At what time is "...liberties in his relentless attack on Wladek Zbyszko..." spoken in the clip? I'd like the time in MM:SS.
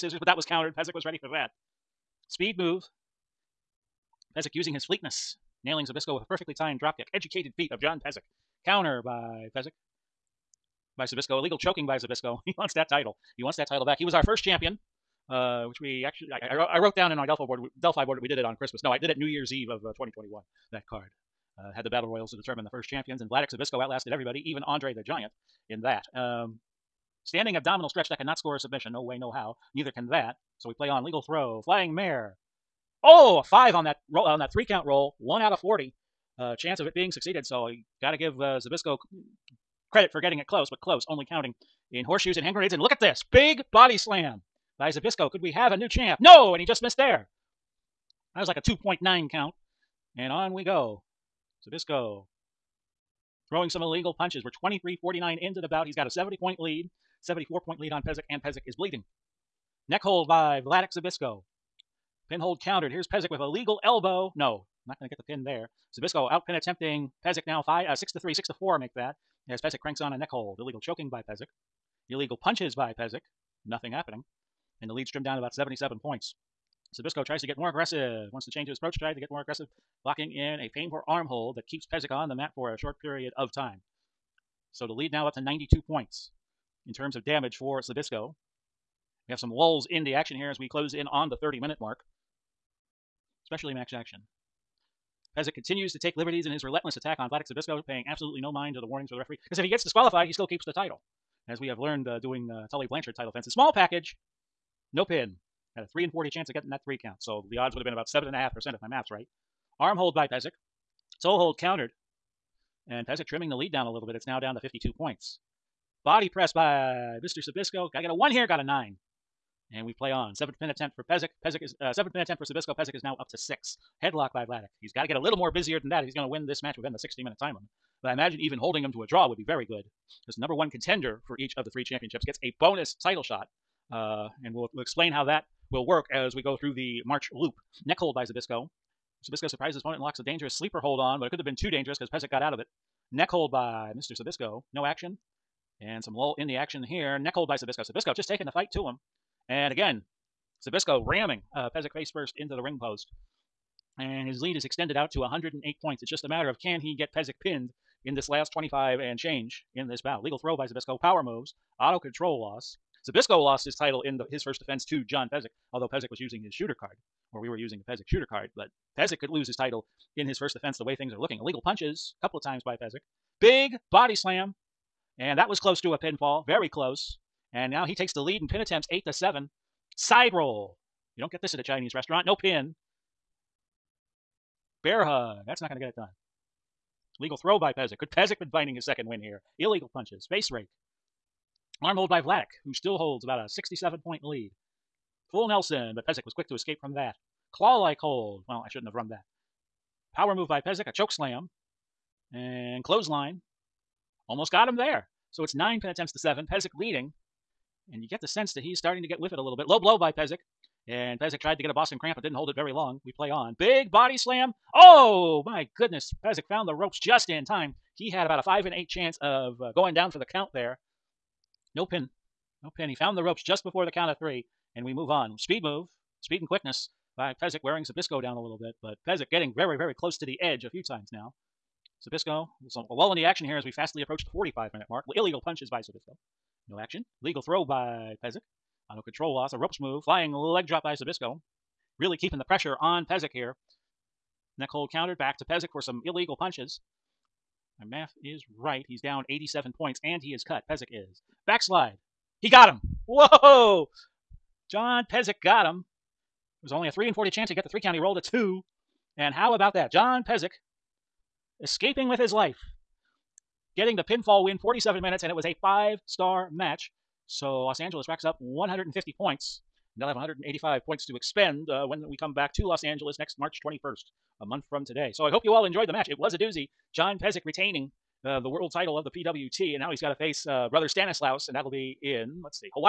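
01:36.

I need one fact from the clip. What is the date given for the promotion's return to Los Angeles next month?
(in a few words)
March 21st.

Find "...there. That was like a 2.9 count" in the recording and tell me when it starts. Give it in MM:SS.
00:46.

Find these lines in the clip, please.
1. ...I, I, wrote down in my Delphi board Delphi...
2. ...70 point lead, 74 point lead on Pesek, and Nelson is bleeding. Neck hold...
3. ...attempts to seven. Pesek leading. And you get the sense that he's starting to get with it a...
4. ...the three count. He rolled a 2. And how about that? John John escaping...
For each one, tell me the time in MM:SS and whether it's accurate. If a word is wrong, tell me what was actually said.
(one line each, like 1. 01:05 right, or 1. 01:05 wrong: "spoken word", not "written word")
1. 00:16 right
2. 00:56 wrong: "Pesek", not "Nelson"
3. 03:25 right
4. 04:17 wrong: "Pesek", not "John".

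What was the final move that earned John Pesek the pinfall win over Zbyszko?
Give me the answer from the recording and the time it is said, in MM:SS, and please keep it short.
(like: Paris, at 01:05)
Backslide, at 04:11.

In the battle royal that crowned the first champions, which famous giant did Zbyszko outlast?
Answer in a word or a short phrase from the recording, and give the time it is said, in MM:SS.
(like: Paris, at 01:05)
Andre the Giant, at 00:24.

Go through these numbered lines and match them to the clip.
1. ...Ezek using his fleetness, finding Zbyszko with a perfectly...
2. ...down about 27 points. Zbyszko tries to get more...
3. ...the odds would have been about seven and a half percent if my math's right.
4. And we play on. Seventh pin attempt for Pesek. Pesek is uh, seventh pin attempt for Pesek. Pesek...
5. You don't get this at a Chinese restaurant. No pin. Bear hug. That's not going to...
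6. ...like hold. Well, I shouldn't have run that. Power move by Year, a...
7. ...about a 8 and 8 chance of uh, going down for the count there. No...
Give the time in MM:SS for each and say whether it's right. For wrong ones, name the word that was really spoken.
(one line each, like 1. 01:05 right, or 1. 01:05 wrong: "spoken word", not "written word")
1. 00:04 wrong: "nailing", not "finding"
2. 01:15 wrong: "77", not "27"
3. 01:47 right
4. 01:59 wrong: "Zbyszko", not "Pesek"
5. 03:01 right
6. 03:17 wrong: "Pesek", not "Year"
7. 03:38 wrong: "5", not "8".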